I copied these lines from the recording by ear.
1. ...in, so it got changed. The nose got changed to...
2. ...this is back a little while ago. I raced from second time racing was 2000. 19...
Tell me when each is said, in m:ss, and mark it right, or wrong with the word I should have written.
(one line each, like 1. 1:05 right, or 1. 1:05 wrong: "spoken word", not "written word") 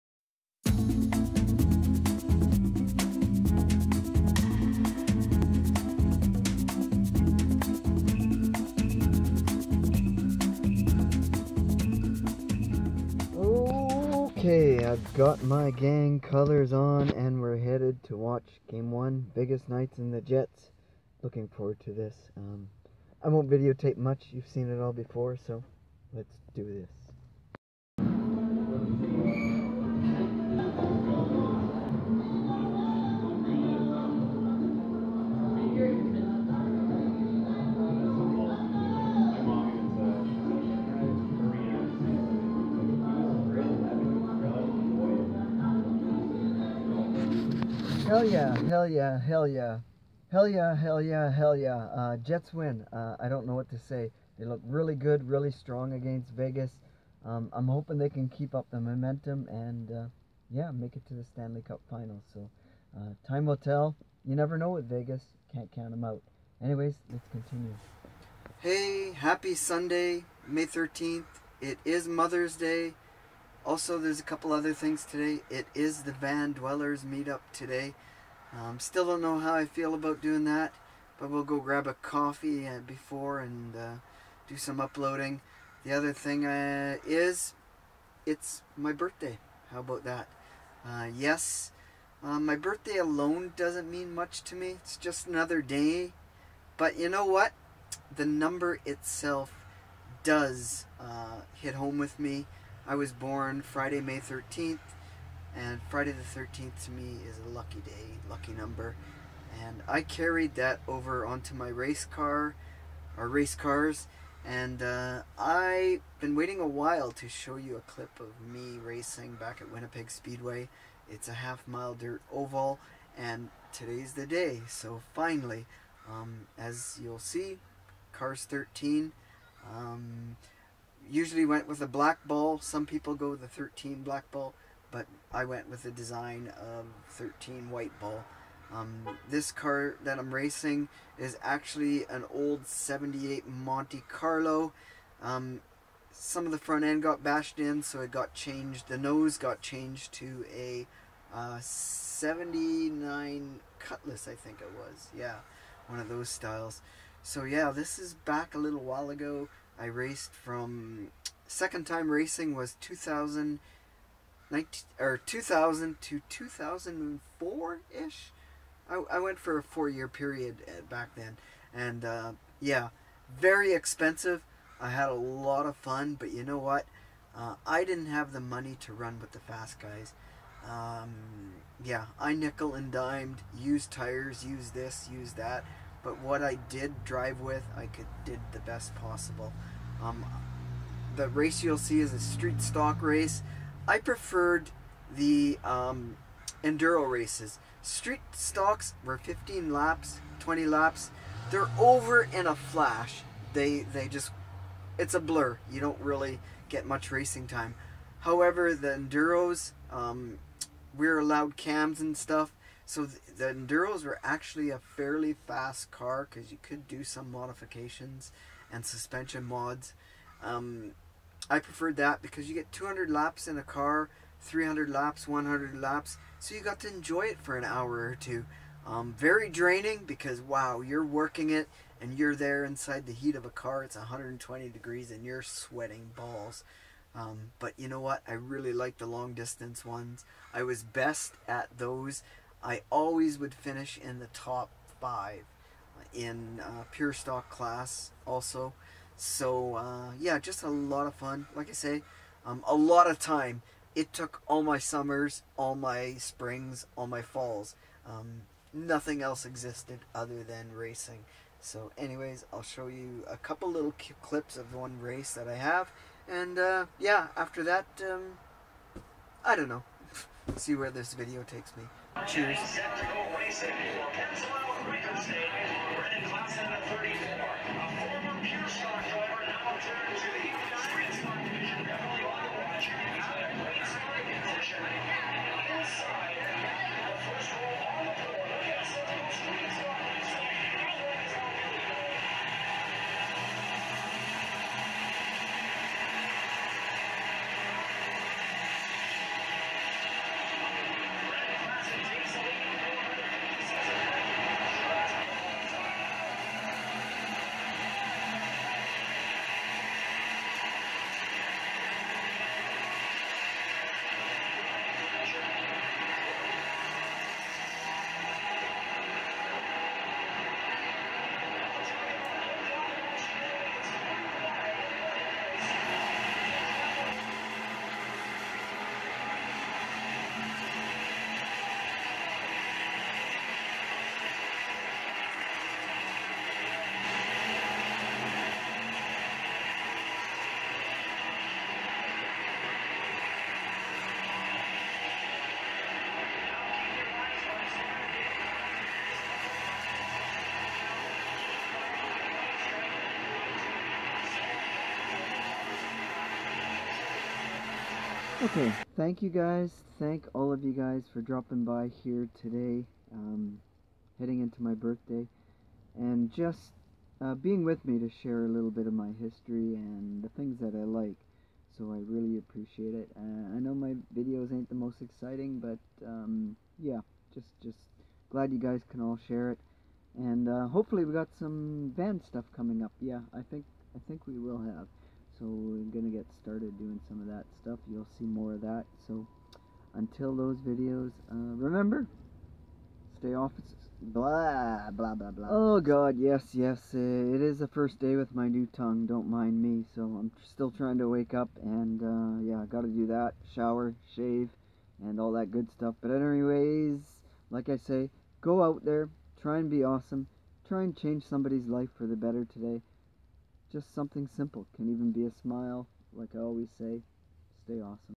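1. 2:27 right
2. 2:37 right.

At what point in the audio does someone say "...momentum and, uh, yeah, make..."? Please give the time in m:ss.
0:58.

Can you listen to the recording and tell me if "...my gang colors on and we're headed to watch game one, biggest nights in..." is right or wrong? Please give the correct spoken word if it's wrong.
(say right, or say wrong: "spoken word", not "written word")
right.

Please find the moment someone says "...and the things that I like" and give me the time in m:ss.
6:09.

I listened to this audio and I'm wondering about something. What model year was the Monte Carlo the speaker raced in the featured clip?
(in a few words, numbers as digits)
78.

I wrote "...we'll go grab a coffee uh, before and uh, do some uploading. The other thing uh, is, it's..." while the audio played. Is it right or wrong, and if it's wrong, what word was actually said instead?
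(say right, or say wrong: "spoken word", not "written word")
right.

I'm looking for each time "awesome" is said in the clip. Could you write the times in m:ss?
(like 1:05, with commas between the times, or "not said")
6:49, 6:57.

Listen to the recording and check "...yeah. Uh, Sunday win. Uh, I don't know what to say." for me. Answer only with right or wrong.
wrong.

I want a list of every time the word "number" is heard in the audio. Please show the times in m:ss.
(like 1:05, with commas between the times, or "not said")
1:38, 1:48.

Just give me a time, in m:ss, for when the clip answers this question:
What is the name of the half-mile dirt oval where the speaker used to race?
1:59.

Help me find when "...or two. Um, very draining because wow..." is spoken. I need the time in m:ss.
3:48.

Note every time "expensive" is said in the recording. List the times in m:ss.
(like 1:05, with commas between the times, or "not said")
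2:53.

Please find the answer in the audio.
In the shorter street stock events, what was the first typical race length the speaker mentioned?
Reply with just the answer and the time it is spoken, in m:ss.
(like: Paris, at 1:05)
15 laps, at 3:19.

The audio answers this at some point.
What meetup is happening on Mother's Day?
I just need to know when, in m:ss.
1:16.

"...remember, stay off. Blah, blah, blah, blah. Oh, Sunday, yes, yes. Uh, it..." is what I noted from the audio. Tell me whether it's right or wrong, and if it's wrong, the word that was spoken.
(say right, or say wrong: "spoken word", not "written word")
wrong: "God", not "Sunday".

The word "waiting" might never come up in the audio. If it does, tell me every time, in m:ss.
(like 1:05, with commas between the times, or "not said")
1:56.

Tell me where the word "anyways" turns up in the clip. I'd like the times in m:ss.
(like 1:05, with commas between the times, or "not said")
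1:06, 4:21, 6:46.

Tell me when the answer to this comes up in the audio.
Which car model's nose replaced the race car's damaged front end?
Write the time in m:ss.
2:33.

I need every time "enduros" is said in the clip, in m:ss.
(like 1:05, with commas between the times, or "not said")
3:16, 3:28, 3:33.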